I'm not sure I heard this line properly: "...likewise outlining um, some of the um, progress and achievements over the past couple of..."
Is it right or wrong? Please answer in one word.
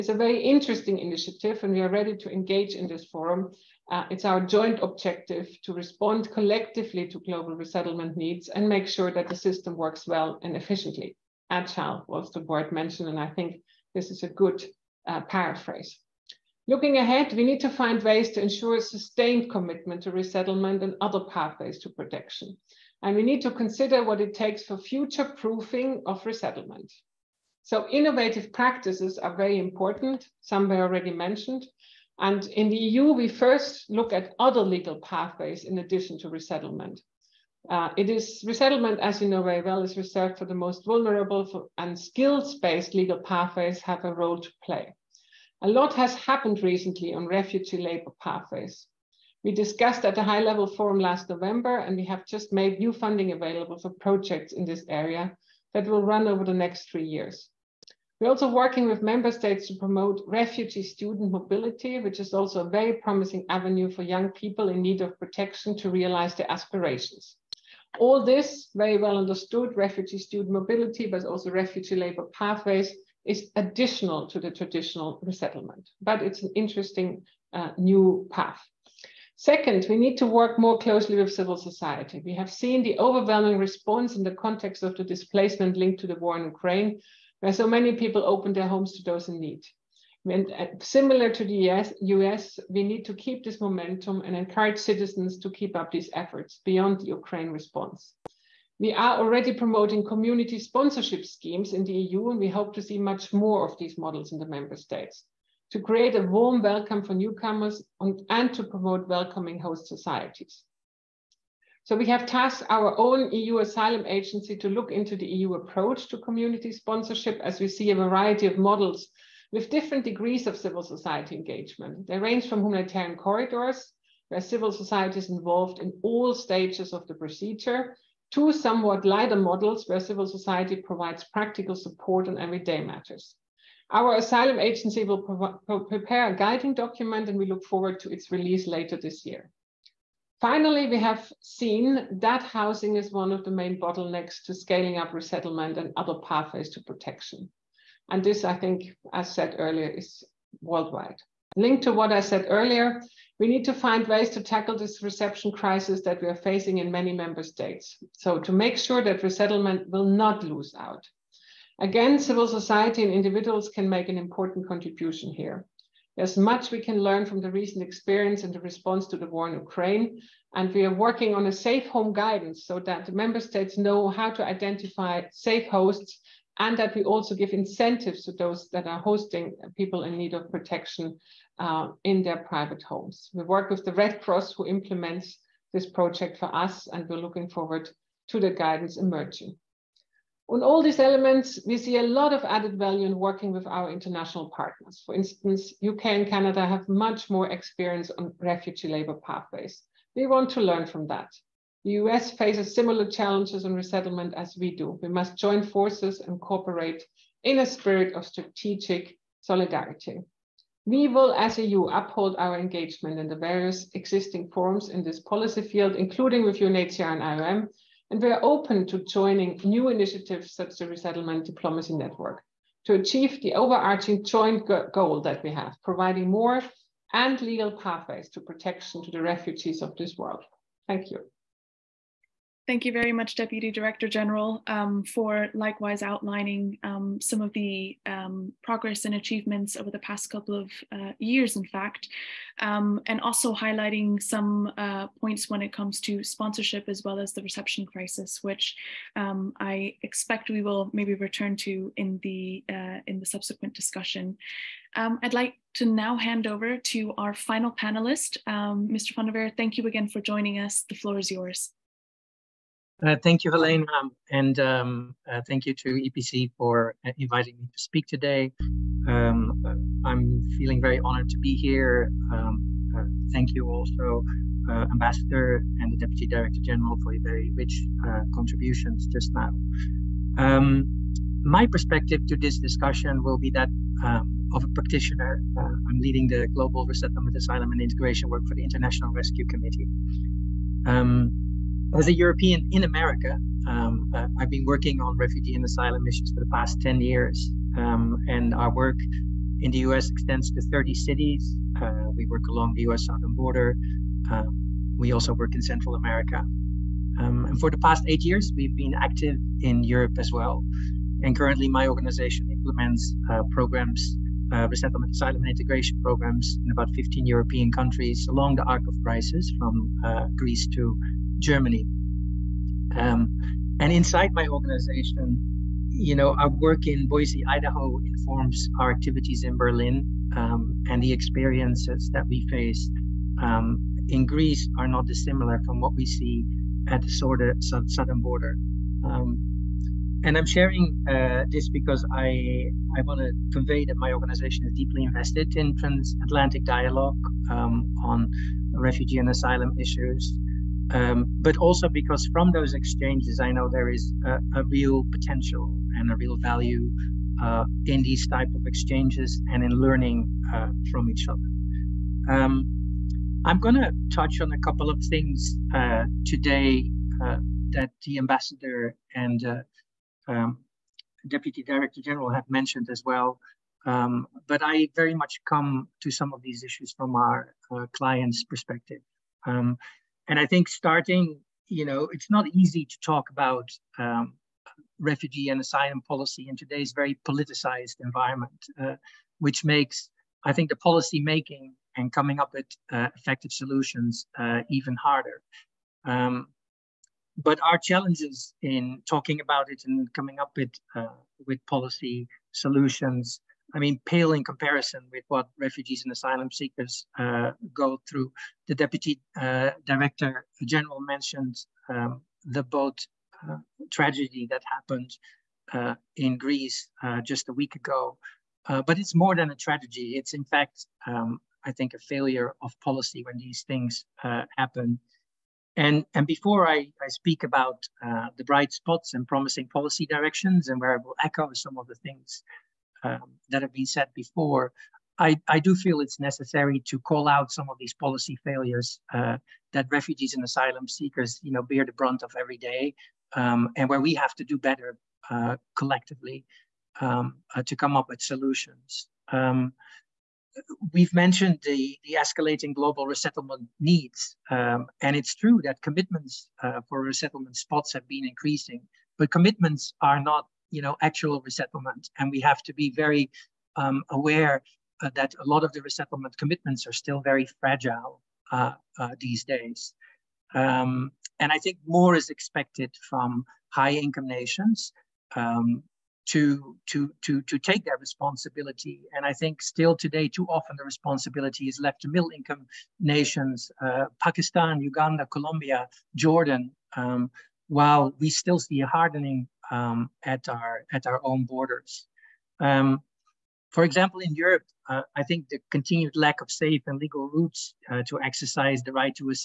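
right.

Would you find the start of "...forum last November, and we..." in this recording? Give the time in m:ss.
0:50.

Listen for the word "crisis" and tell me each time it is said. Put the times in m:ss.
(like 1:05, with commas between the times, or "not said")
2:35, 4:07, 5:19.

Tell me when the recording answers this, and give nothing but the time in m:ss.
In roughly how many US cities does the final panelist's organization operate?
5:00.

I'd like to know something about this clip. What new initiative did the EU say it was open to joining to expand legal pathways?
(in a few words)
Resettlement Diplomacy Network.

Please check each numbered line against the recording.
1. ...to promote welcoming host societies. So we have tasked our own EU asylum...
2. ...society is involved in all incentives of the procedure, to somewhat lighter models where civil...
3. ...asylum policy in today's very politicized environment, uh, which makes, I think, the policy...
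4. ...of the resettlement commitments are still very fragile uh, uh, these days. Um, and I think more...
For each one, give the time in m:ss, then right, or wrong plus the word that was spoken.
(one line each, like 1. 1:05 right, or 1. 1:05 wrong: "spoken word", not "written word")
1. 1:48 right
2. 2:04 wrong: "stages", not "incentives"
3. 6:25 right
4. 7:45 right.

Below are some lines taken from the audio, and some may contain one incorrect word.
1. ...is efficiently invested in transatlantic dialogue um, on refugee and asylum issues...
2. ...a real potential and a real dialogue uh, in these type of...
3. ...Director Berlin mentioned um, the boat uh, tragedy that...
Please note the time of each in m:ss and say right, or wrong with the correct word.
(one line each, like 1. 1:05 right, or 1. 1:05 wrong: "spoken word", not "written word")
1. 5:44 wrong: "deeply", not "efficiently"
2. 5:54 wrong: "value", not "dialogue"
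3. 6:49 wrong: "General", not "Berlin".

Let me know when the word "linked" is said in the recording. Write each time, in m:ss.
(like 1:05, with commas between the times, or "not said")
1:25, 2:31.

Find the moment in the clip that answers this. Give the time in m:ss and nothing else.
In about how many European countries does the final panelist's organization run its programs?
5:16.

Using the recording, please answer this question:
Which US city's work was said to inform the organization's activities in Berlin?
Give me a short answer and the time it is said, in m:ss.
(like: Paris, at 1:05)
Boise, Idaho, at 5:27.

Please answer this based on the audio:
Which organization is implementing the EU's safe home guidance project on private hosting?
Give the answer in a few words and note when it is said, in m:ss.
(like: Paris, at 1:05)
Red Cross, at 3:03.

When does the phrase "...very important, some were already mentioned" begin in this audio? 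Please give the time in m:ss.
0:29.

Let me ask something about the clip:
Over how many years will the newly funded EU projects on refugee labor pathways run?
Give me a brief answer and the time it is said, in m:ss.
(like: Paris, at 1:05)
3, at 0:56.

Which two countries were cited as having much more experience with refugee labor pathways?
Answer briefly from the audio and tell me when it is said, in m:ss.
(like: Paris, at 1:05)
UK and Canada, at 3:15.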